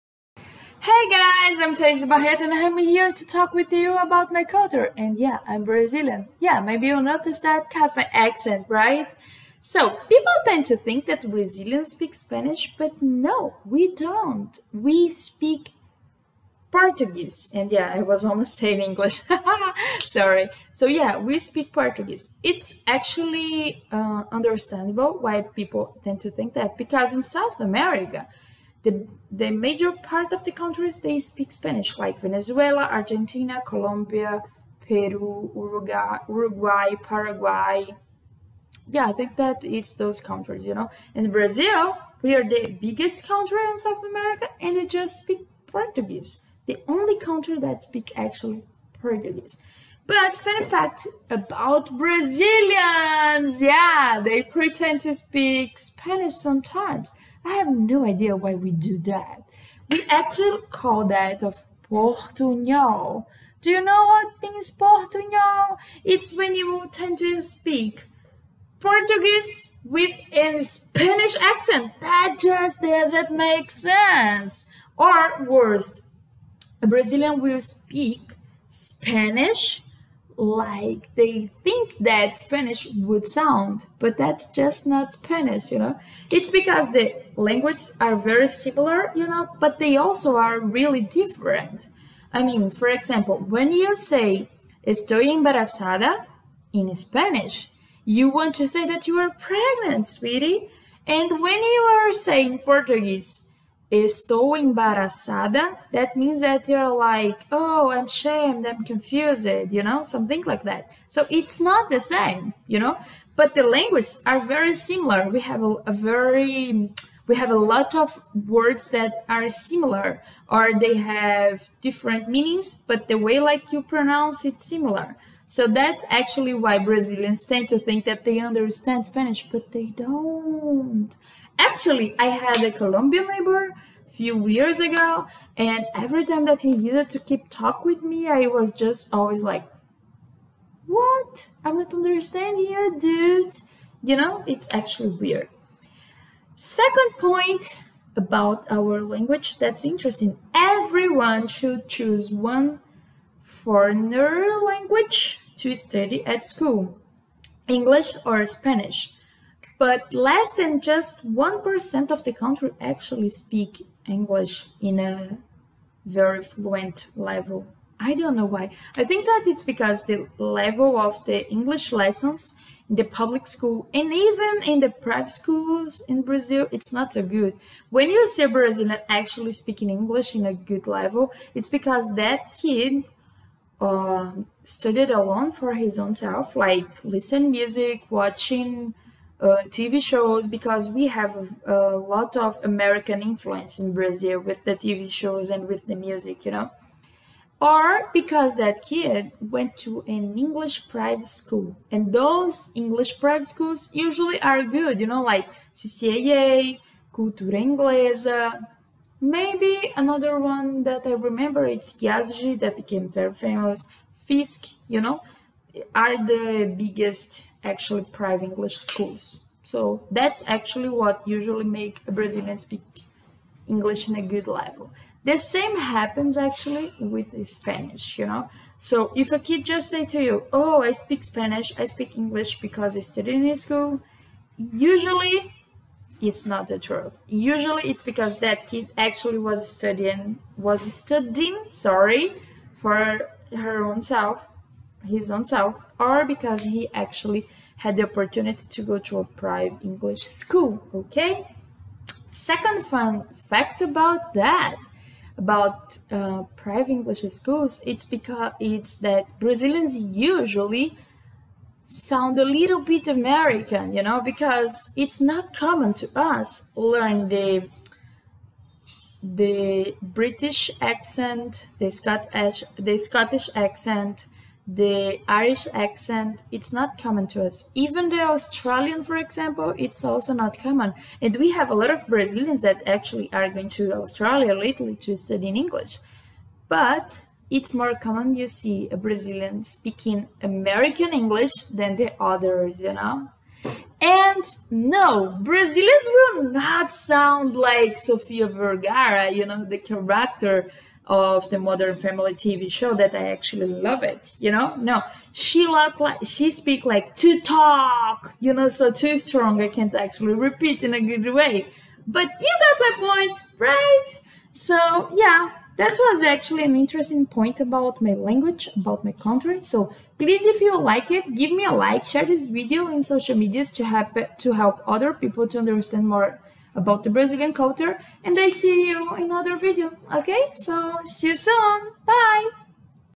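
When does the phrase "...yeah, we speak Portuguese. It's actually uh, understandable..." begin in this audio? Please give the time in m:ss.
0:20.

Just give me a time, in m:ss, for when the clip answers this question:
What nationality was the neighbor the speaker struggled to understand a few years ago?
2:12.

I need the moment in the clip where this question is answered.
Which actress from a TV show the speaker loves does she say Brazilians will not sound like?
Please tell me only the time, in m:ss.
4:57.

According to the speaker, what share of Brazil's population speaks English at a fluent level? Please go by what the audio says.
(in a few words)
less than 1%.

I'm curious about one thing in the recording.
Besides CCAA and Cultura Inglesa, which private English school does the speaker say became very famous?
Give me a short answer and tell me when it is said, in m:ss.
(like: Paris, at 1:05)
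Yázigi, at 3:31.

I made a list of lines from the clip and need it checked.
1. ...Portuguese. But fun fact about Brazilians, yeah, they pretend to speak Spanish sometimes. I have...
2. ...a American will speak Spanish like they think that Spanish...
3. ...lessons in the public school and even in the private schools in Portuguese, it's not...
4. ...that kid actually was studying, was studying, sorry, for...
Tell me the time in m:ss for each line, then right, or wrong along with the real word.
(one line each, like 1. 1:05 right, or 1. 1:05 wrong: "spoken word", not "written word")
1. 0:49 right
2. 1:16 wrong: "Brazilian", not "American"
3. 2:51 wrong: "Brazil", not "Portuguese"
4. 3:58 right.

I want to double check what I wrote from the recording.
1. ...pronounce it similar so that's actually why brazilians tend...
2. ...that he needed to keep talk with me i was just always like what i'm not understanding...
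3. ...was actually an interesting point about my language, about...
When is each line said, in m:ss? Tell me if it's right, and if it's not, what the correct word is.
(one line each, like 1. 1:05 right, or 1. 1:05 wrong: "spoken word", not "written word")
1. 2:03 right
2. 2:16 right
3. 5:15 right.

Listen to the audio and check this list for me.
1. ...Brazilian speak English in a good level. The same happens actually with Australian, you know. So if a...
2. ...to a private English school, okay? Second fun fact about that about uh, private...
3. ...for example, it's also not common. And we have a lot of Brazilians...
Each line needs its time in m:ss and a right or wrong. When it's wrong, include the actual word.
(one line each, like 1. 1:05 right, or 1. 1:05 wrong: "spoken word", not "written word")
1. 3:42 wrong: "Spanish", not "Australian"
2. 4:08 right
3. 4:39 right.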